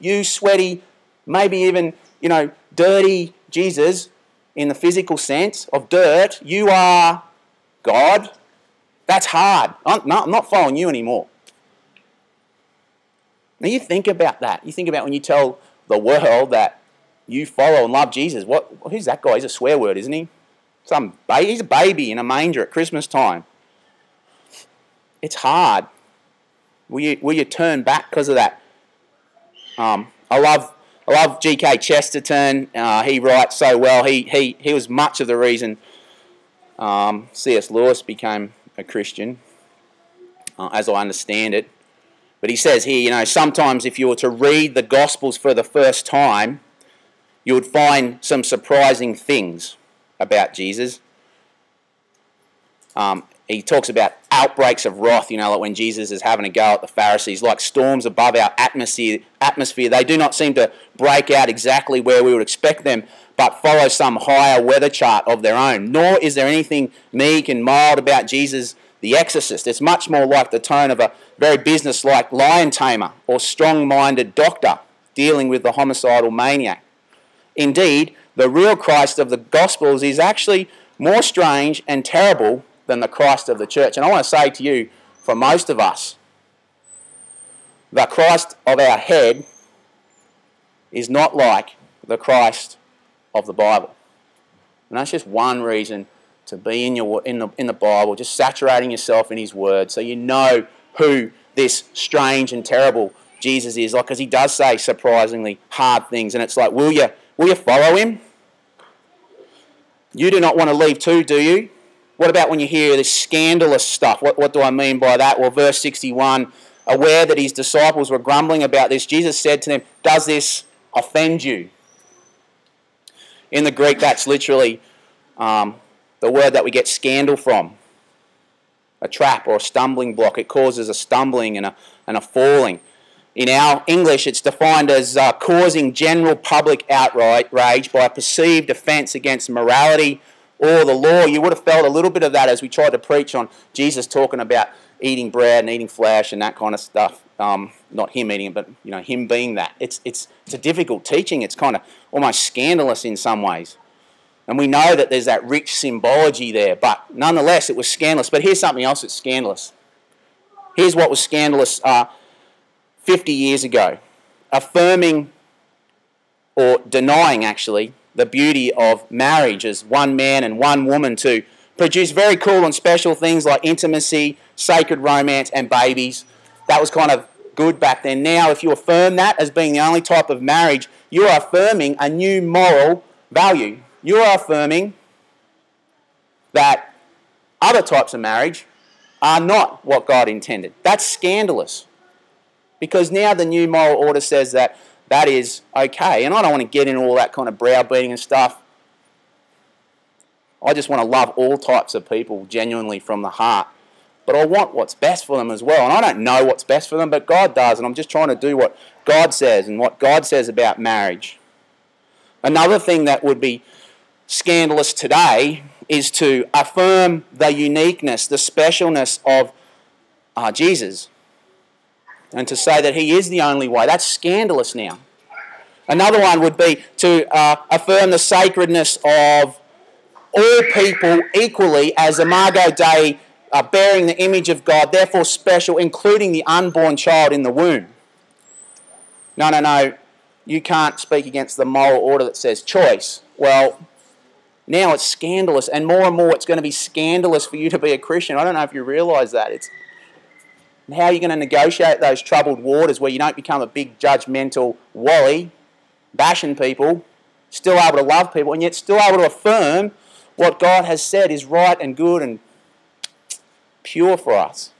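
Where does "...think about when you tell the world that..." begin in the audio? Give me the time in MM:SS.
00:14.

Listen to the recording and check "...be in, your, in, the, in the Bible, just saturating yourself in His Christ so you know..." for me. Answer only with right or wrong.
wrong.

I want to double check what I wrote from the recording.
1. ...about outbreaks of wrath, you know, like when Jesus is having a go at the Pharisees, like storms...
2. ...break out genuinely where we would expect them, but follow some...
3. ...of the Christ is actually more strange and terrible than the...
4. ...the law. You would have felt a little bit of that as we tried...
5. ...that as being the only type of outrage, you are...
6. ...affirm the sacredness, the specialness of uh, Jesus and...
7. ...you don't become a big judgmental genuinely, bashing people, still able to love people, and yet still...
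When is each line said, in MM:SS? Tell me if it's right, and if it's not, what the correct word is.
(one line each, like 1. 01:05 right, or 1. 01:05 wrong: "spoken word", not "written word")
1. 00:53 right
2. 01:00 wrong: "exactly", not "genuinely"
3. 01:19 wrong: "Gospels", not "Christ"
4. 02:20 right
5. 02:59 wrong: "marriage", not "outrage"
6. 03:36 wrong: "uniqueness", not "sacredness"
7. 04:13 wrong: "wally", not "genuinely".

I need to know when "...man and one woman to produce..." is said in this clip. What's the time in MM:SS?
02:50.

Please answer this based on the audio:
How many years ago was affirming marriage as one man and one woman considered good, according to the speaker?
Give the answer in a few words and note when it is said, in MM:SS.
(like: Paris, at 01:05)
50, at 02:43.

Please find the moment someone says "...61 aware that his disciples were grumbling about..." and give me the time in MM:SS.
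01:55.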